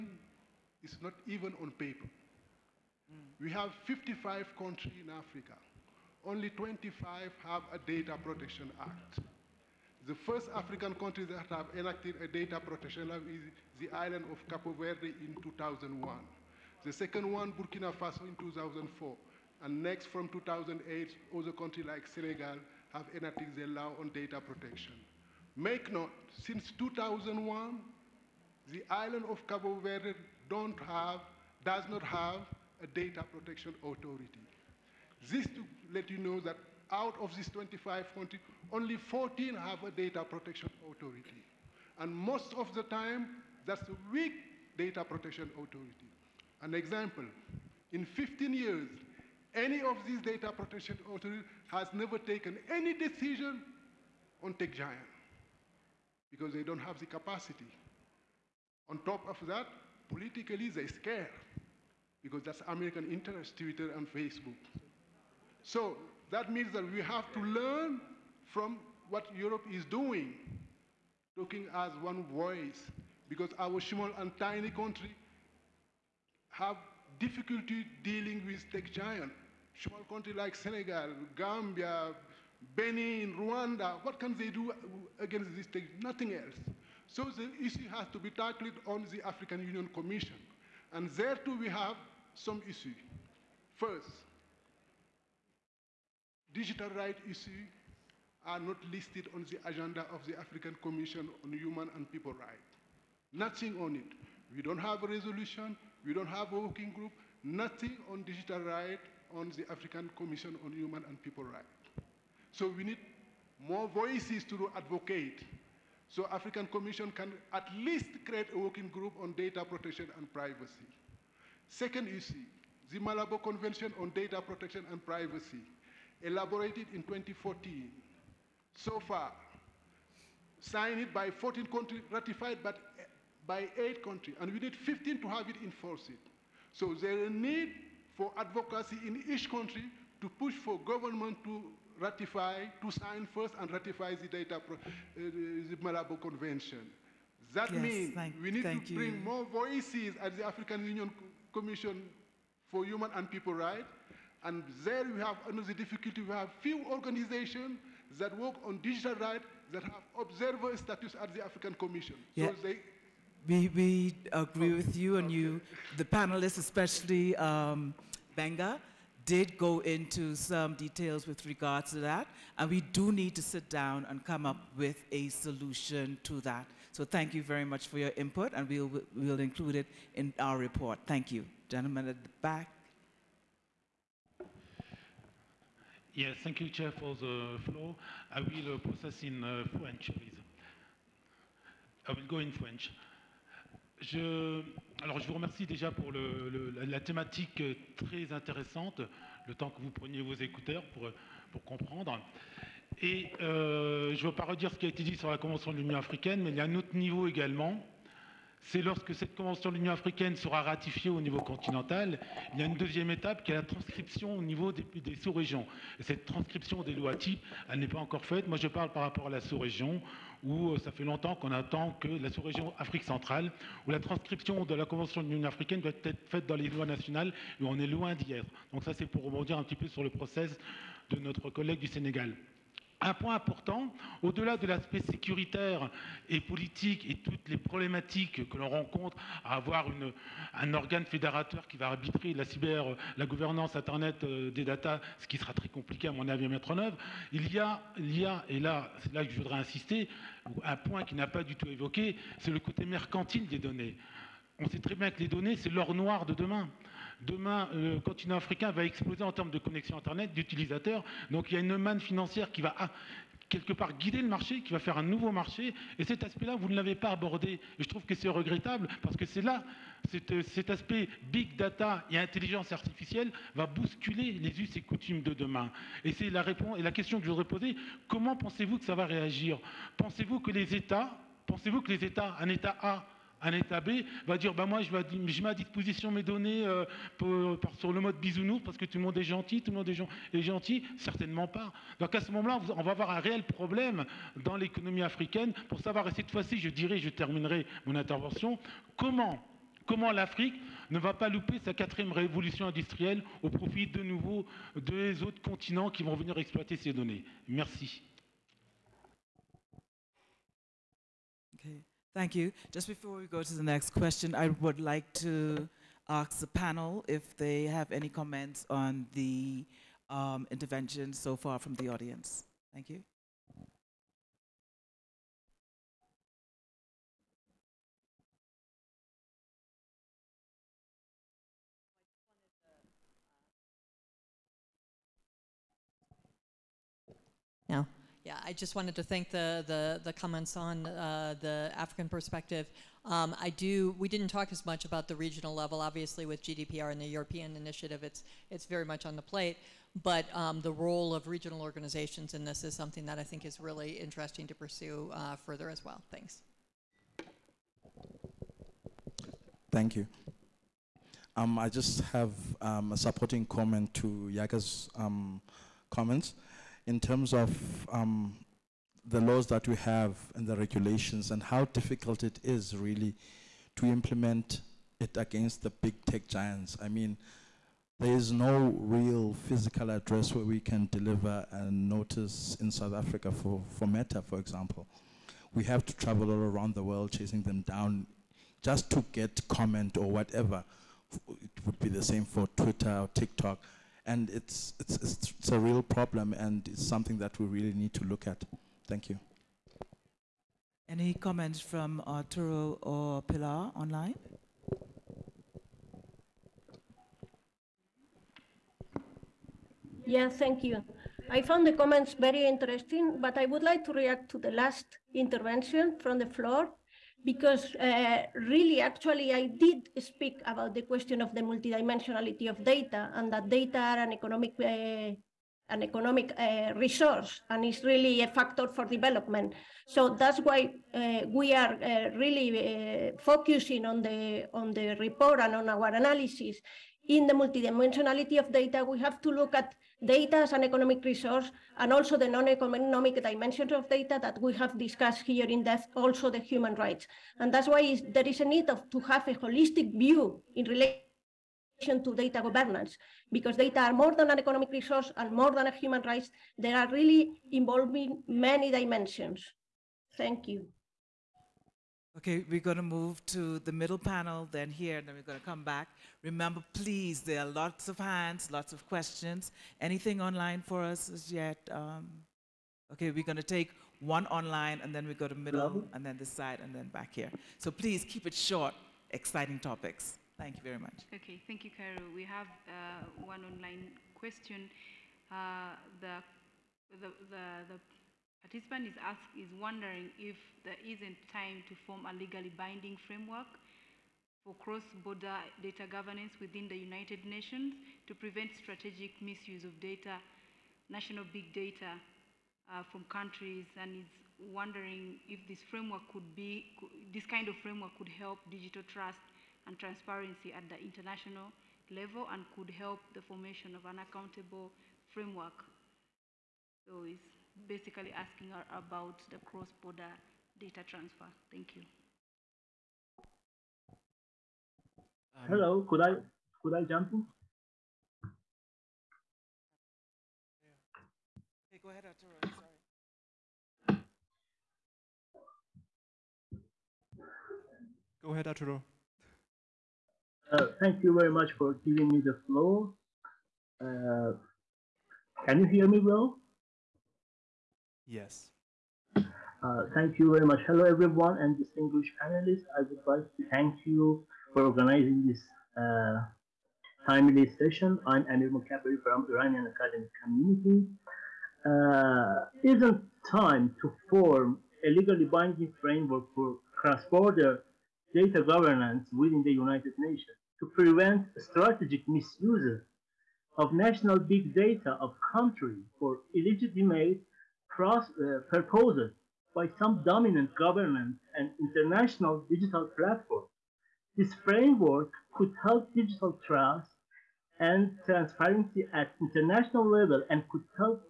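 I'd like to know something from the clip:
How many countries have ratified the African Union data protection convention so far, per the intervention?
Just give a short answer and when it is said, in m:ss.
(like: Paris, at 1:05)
8, at 2:12.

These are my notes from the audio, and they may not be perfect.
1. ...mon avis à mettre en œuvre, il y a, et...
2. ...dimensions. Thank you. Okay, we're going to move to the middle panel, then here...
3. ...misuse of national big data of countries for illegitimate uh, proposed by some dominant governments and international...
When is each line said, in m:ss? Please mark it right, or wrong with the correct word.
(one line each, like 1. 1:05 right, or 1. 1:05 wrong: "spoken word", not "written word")
1. 4:06 right
2. 7:38 right
3. 9:32 right.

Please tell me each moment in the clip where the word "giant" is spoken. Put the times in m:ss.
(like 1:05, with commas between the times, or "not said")
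0:54, 1:18, 6:16.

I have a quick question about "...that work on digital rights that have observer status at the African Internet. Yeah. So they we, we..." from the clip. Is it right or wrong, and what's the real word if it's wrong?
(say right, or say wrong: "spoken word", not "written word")
wrong: "Commission", not "Internet".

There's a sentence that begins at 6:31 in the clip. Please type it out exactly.
It would be the same for Twitter or TikTok.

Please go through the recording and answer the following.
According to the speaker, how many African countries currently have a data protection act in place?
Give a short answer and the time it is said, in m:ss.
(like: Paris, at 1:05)
25, at 0:06.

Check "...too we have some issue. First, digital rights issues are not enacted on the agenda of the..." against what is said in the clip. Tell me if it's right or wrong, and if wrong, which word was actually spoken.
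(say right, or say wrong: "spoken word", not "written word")
wrong: "listed", not "enacted".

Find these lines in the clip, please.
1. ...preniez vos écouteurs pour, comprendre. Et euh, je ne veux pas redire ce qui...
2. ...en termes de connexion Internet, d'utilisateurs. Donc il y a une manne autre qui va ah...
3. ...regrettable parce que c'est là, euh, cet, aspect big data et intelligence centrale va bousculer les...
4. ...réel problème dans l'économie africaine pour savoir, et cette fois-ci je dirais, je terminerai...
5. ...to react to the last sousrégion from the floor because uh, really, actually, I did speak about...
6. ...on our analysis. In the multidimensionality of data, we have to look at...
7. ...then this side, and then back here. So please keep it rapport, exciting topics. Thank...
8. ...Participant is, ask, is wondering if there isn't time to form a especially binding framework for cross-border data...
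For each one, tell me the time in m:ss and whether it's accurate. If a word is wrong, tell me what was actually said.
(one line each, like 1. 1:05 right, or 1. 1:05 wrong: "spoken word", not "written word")
1. 3:19 right
2. 4:19 wrong: "financière", not "autre"
3. 4:28 wrong: "artificielle", not "centrale"
4. 4:53 right
5. 6:53 wrong: "intervention", not "sousrégion"
6. 7:15 right
7. 7:56 wrong: "short", not "rapport"
8. 8:08 wrong: "legally", not "especially".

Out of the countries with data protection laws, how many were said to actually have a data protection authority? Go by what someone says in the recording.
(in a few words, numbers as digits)
14.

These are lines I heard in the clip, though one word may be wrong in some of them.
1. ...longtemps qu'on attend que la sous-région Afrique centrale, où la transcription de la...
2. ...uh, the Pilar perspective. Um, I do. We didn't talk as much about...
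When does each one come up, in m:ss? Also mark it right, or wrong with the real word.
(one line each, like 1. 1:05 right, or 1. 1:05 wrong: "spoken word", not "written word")
1. 3:41 right
2. 5:40 wrong: "African", not "Pilar".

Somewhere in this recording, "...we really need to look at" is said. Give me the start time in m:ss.
6:37.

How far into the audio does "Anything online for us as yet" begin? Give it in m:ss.
7:49.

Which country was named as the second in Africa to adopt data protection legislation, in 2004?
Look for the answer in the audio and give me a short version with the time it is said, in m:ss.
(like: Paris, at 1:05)
Burkina Faso, at 0:17.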